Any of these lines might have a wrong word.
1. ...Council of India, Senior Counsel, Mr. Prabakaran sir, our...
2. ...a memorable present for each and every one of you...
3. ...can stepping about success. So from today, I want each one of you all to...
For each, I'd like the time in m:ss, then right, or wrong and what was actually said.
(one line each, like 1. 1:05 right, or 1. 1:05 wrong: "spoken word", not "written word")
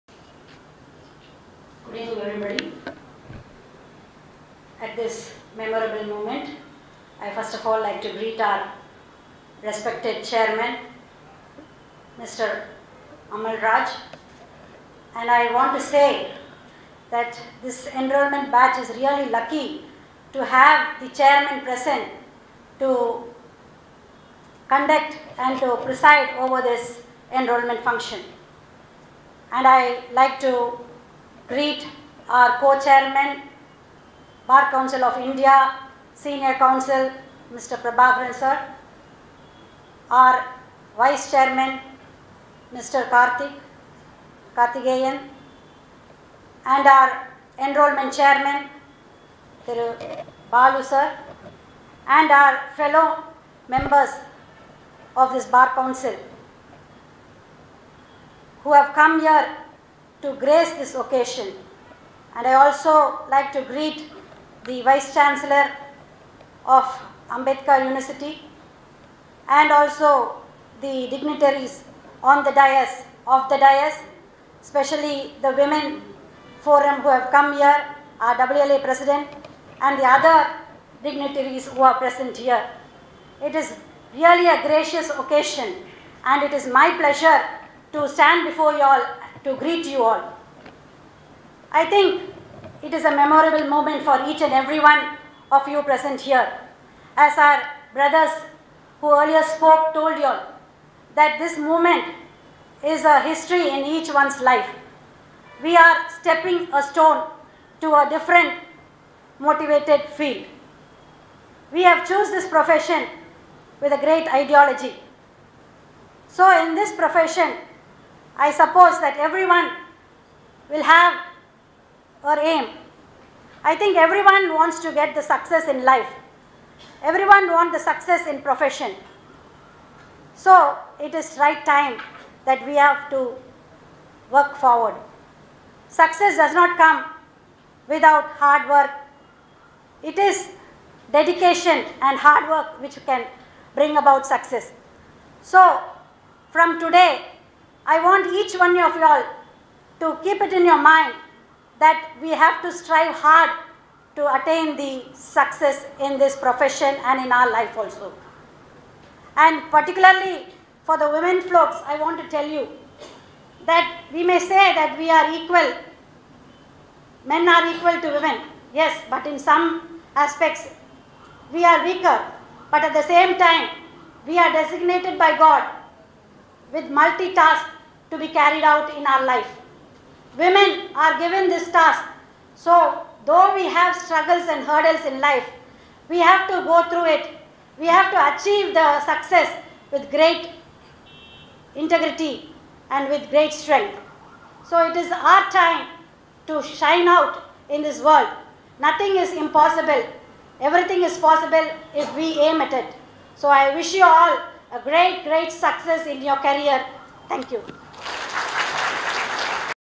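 1. 0:34 right
2. 1:33 wrong: "moment", not "present"
3. 2:23 wrong: "bring", not "stepping".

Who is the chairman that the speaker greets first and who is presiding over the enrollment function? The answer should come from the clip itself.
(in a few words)
Amal Raj.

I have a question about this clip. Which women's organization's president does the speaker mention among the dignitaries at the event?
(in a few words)
WLA.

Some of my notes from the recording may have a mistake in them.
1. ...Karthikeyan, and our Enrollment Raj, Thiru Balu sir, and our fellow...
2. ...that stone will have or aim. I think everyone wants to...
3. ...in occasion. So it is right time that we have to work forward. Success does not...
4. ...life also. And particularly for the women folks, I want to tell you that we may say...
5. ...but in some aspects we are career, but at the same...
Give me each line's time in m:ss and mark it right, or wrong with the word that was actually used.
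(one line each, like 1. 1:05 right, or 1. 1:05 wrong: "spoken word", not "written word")
1. 0:44 wrong: "Chairman", not "Raj"
2. 1:58 wrong: "everyone", not "stone"
3. 2:08 wrong: "profession", not "occasion"
4. 2:37 right
5. 2:49 wrong: "weaker", not "career".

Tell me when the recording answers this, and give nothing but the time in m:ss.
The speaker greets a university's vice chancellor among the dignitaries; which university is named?
1:07.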